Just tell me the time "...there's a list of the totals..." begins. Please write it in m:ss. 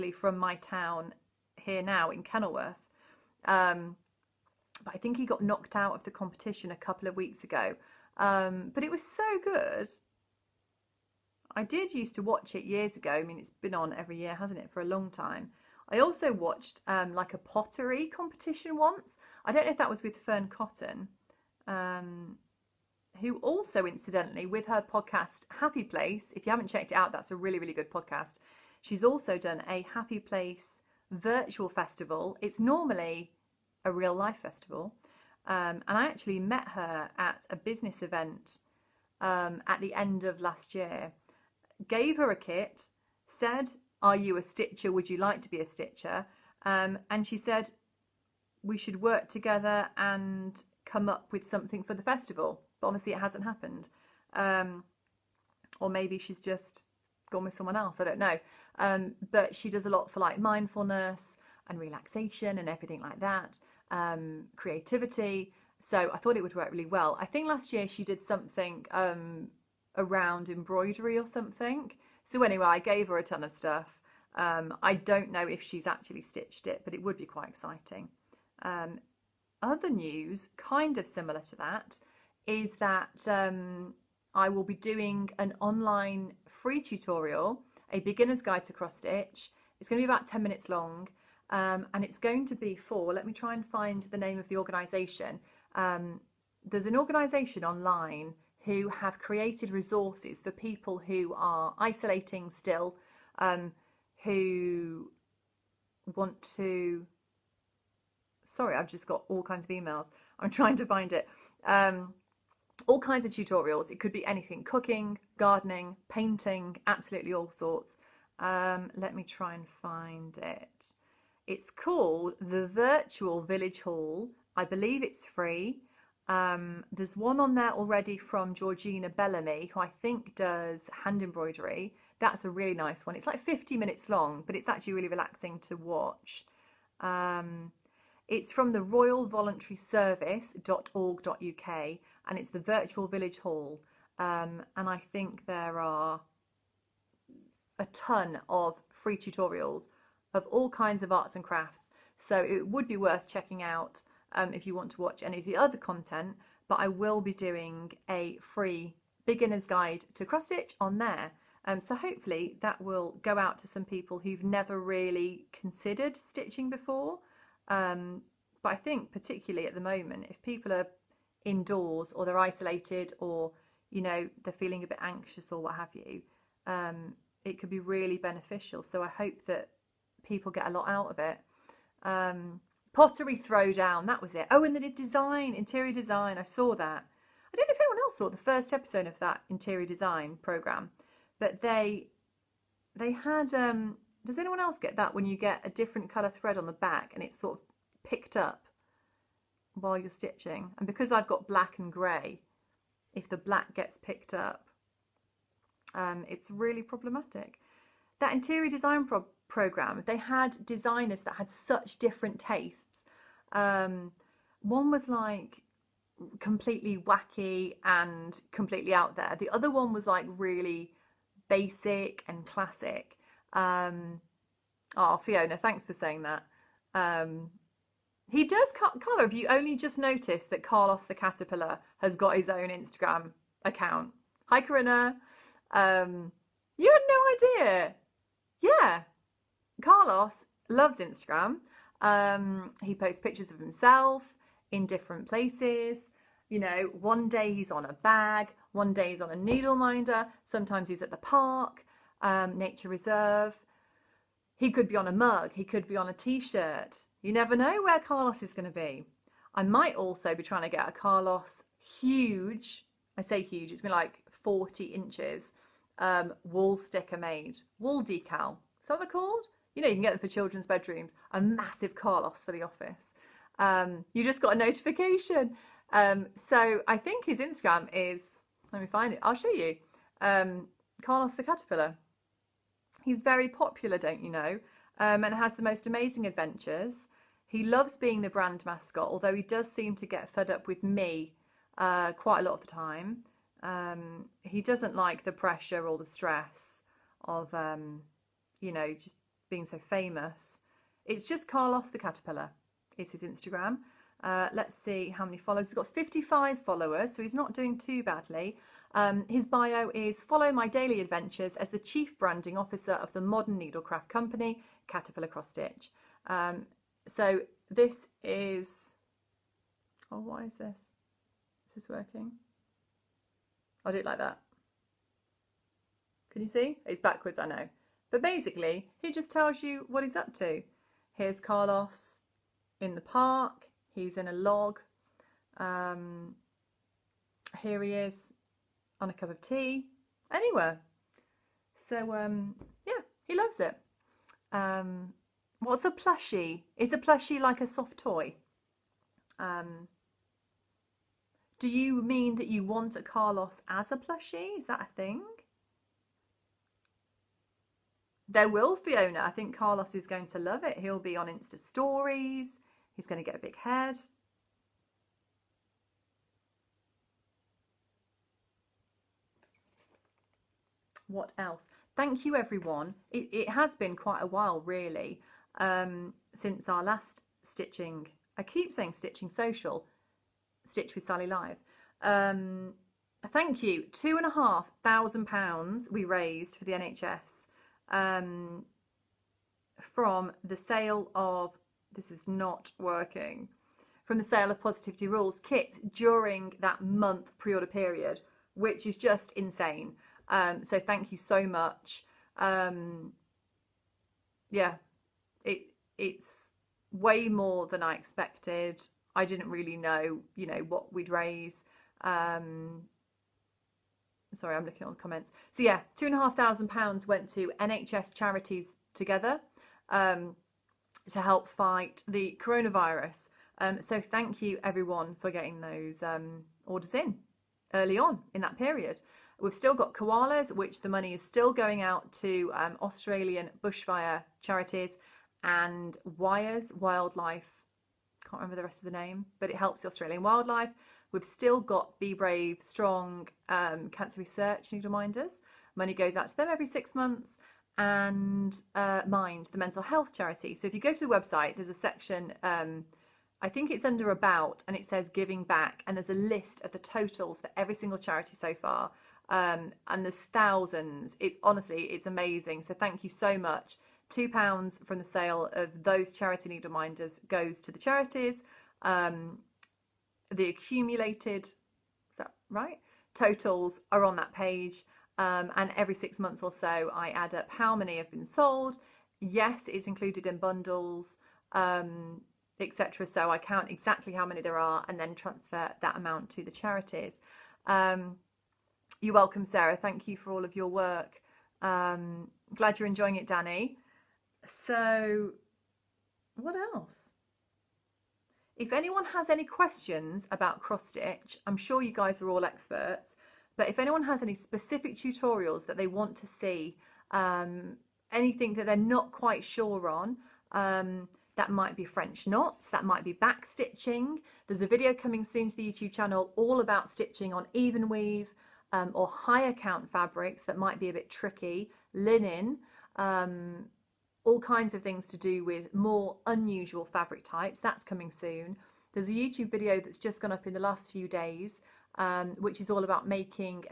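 7:35.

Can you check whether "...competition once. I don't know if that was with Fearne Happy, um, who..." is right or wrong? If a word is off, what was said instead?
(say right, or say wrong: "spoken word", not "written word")
wrong: "Cotton", not "Happy".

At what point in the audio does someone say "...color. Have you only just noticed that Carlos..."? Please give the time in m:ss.
3:48.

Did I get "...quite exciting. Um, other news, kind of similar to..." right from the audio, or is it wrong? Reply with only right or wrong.
right.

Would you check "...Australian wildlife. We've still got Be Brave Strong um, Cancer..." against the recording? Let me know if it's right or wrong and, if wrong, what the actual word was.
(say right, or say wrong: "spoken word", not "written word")
right.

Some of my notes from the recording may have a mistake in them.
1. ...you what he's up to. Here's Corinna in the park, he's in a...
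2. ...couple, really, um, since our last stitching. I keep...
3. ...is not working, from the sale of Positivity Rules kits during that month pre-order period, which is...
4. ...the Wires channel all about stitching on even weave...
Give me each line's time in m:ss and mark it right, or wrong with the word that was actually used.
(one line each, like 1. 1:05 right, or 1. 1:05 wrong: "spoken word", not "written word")
1. 5:29 wrong: "Carlos", not "Corinna"
2. 6:14 wrong: "while", not "couple"
3. 6:32 right
4. 8:35 wrong: "YouTube", not "Wires".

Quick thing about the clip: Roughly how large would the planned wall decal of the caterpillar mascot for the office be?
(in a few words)
40 inches.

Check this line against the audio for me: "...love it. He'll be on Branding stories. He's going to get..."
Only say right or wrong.
wrong.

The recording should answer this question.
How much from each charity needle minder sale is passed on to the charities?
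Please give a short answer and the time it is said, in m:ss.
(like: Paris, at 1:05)
£2, at 7:44.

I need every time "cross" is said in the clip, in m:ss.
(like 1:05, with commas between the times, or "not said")
1:28, 2:40, 5:15, 8:20.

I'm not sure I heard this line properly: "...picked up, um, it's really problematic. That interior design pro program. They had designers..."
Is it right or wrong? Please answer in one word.
right.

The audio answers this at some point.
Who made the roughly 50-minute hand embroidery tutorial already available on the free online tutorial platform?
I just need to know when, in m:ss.
2:08.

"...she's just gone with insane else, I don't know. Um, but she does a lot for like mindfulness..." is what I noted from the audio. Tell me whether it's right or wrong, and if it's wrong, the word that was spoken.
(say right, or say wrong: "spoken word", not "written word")
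wrong: "someone", not "insane".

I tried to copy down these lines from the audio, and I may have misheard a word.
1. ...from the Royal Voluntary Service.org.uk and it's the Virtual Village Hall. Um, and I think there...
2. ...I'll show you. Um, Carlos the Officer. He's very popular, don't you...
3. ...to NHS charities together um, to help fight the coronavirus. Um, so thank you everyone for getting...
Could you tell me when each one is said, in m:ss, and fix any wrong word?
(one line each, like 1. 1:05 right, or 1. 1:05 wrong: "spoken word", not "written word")
1. 2:18 right
2. 4:39 wrong: "Caterpillar", not "Officer"
3. 6:57 right.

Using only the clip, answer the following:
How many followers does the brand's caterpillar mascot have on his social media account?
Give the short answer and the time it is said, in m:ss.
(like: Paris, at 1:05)
55, at 5:05.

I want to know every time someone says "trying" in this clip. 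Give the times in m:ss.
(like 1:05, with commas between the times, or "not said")
1:50, 4:20.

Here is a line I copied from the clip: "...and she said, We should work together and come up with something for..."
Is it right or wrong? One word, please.
right.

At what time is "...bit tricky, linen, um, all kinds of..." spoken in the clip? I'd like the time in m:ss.
8:40.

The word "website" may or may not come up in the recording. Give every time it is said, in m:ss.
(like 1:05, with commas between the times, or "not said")
7:31.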